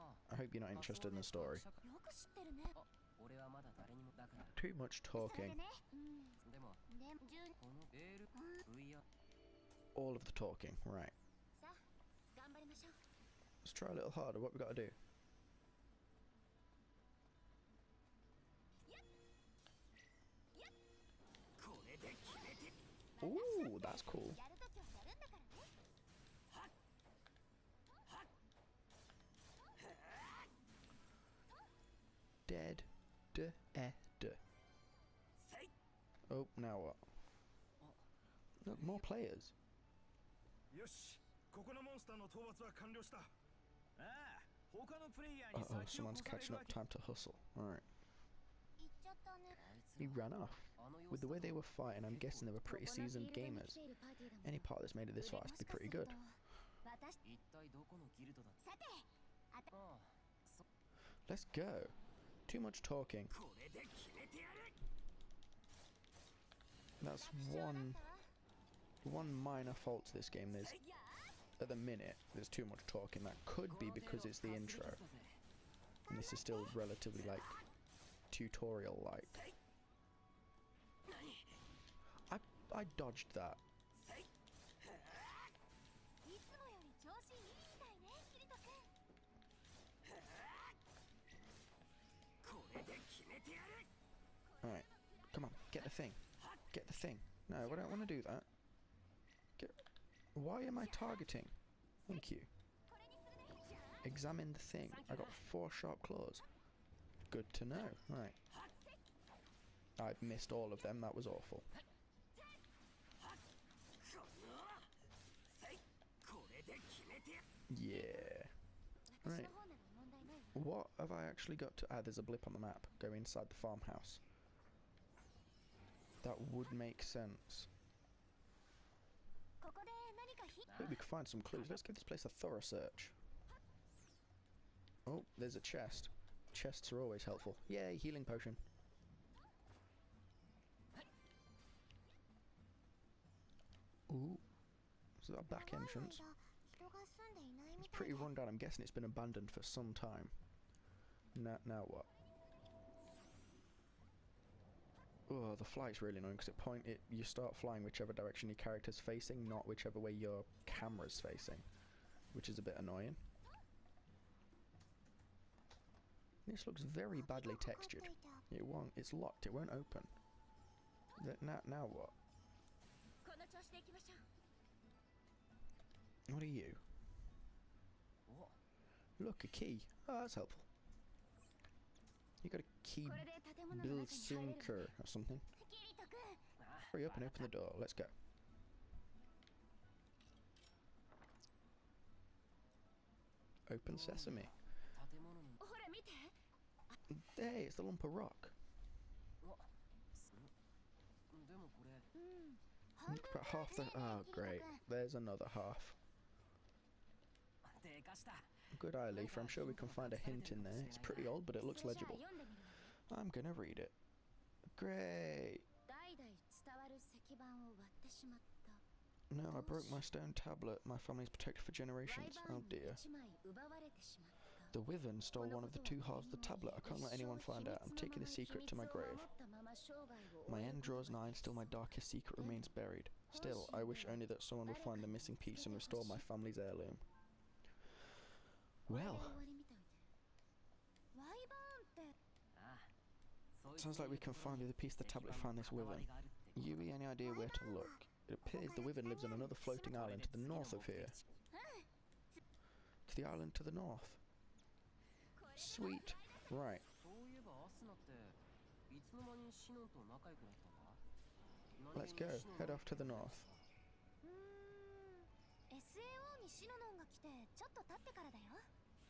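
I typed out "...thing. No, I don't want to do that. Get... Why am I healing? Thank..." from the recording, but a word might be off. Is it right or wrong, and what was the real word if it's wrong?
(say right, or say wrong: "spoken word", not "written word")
wrong: "targeting", not "healing".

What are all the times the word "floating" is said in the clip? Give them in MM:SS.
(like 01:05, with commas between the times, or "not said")
04:09.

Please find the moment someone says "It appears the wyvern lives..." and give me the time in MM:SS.
04:08.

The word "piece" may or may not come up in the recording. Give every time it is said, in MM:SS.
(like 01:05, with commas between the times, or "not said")
03:55, 04:04.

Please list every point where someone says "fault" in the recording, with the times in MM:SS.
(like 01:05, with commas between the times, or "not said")
01:09.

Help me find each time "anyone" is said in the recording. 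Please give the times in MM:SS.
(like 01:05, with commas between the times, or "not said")
03:47.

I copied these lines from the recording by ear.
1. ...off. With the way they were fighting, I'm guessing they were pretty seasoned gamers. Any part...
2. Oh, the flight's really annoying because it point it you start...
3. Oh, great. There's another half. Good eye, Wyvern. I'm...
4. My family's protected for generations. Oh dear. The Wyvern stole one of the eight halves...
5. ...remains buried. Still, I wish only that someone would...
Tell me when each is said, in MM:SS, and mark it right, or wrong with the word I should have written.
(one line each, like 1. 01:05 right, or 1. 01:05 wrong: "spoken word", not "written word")
1. 00:50 right
2. 02:35 right
3. 03:23 wrong: "Leaf", not "Wyvern"
4. 03:40 wrong: "two", not "eight"
5. 03:52 right.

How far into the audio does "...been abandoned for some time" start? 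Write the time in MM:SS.
02:28.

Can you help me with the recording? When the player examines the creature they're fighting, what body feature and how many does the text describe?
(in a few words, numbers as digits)
4 sharp claws.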